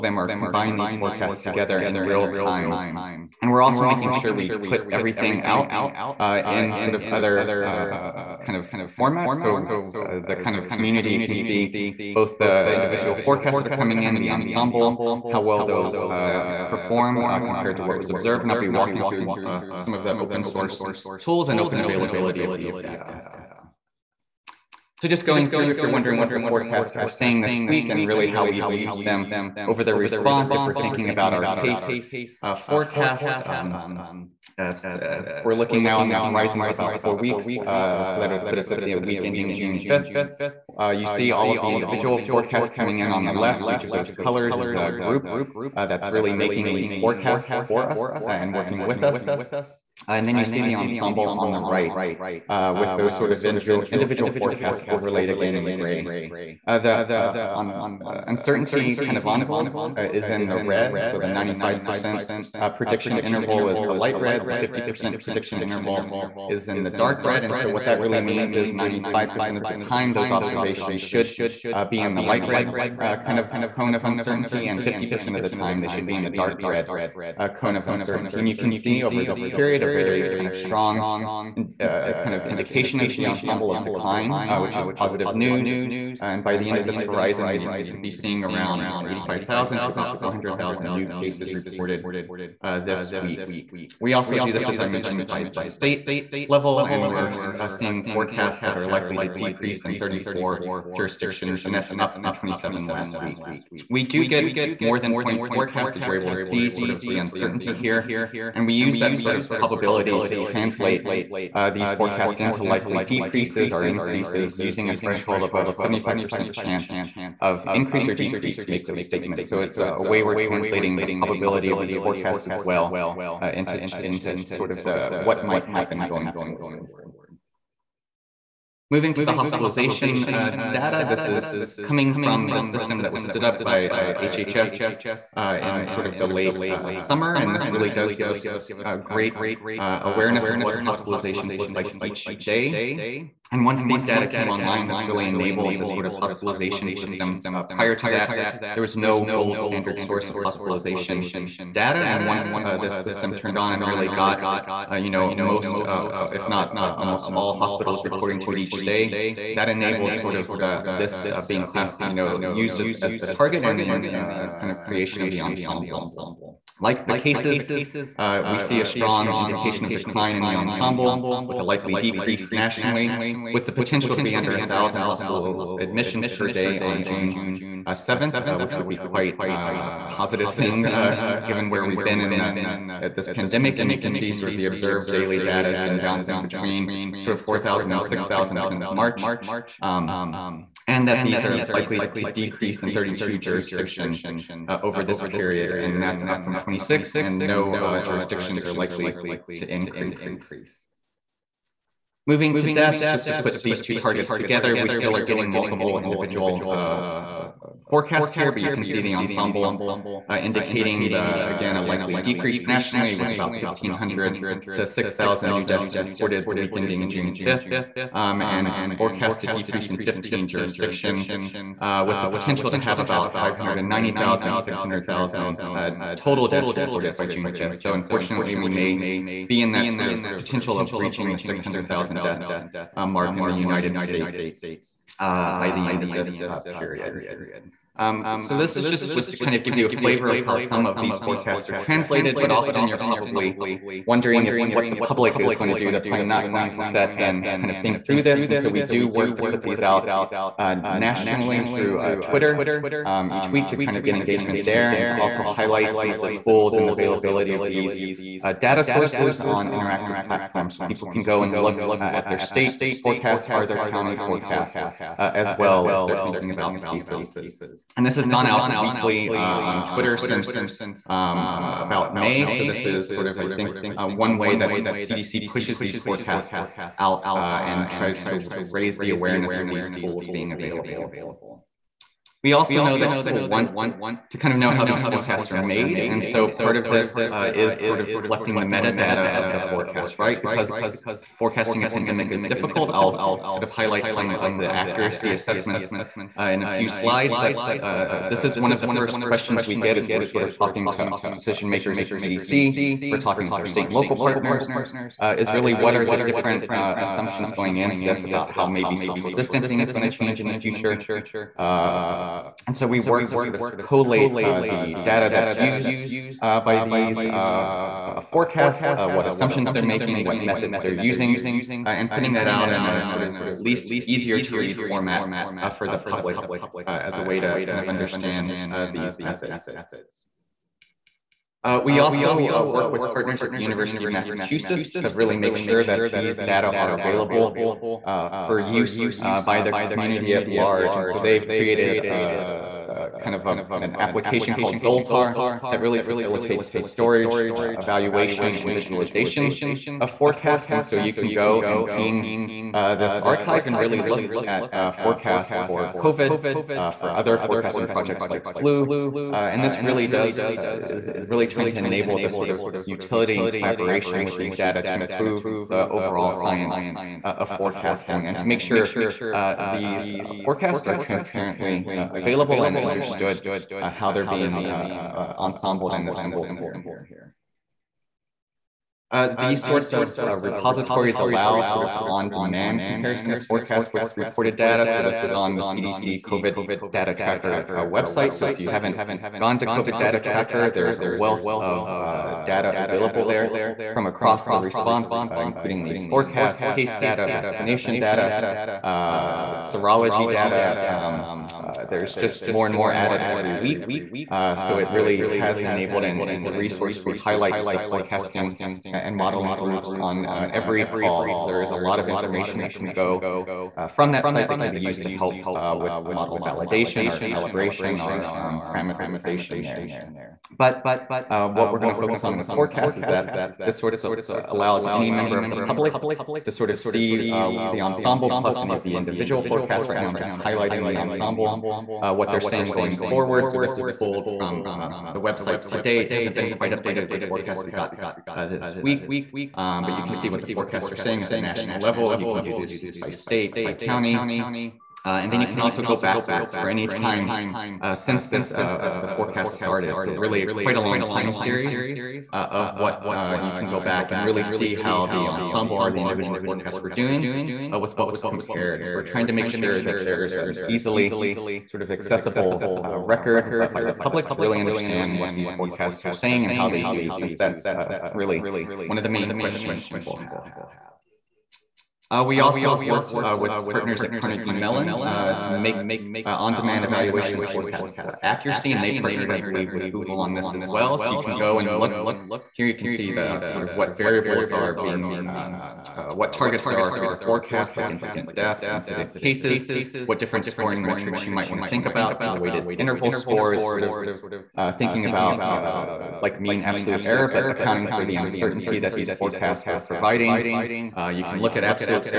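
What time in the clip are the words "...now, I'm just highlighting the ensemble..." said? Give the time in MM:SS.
07:09.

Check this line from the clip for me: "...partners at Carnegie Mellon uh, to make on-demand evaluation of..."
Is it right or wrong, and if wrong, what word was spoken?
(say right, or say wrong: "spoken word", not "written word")
right.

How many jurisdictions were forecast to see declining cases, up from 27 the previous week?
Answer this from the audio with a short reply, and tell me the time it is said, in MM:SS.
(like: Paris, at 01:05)
34, at 01:39.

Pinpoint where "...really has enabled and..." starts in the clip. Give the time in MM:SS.
06:44.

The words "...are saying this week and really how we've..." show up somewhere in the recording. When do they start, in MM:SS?
00:26.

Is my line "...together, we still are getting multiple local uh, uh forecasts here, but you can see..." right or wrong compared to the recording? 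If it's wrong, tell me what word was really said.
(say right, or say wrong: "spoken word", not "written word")
wrong: "individual", not "local".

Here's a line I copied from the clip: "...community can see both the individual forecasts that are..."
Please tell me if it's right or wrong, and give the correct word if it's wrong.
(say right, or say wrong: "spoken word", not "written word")
right.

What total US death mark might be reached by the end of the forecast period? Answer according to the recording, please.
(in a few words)
600,000.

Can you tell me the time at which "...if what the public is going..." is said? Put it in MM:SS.
04:04.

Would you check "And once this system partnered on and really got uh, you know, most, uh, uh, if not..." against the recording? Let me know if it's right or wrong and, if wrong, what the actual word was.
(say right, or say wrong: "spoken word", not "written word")
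wrong: "turned", not "partnered".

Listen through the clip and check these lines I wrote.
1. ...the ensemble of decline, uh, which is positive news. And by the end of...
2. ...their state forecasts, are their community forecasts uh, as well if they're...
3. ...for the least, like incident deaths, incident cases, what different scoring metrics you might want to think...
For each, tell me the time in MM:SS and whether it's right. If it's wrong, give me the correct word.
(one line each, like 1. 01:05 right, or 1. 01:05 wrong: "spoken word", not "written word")
1. 01:23 right
2. 04:22 wrong: "county", not "community"
3. 08:06 wrong: "forecast", not "least".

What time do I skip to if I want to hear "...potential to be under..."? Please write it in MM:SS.
02:53.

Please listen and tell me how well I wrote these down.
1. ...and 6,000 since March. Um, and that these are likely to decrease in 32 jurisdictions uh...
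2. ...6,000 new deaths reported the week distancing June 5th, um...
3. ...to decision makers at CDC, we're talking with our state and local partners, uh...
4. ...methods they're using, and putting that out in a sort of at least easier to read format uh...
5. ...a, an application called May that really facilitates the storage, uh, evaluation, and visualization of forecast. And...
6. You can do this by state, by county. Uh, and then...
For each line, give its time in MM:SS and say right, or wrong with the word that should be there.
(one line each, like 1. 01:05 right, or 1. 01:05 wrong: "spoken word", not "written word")
1. 03:07 right
2. 03:34 wrong: "ending", not "distancing"
3. 05:00 right
4. 05:20 right
5. 05:43 wrong: "Zoltar", not "May"
6. 07:22 right.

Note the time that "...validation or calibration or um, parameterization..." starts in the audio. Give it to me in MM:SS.
06:56.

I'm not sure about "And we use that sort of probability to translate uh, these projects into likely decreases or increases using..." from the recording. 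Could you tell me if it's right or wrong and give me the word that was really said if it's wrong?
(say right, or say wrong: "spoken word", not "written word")
wrong: "forecasts", not "projects".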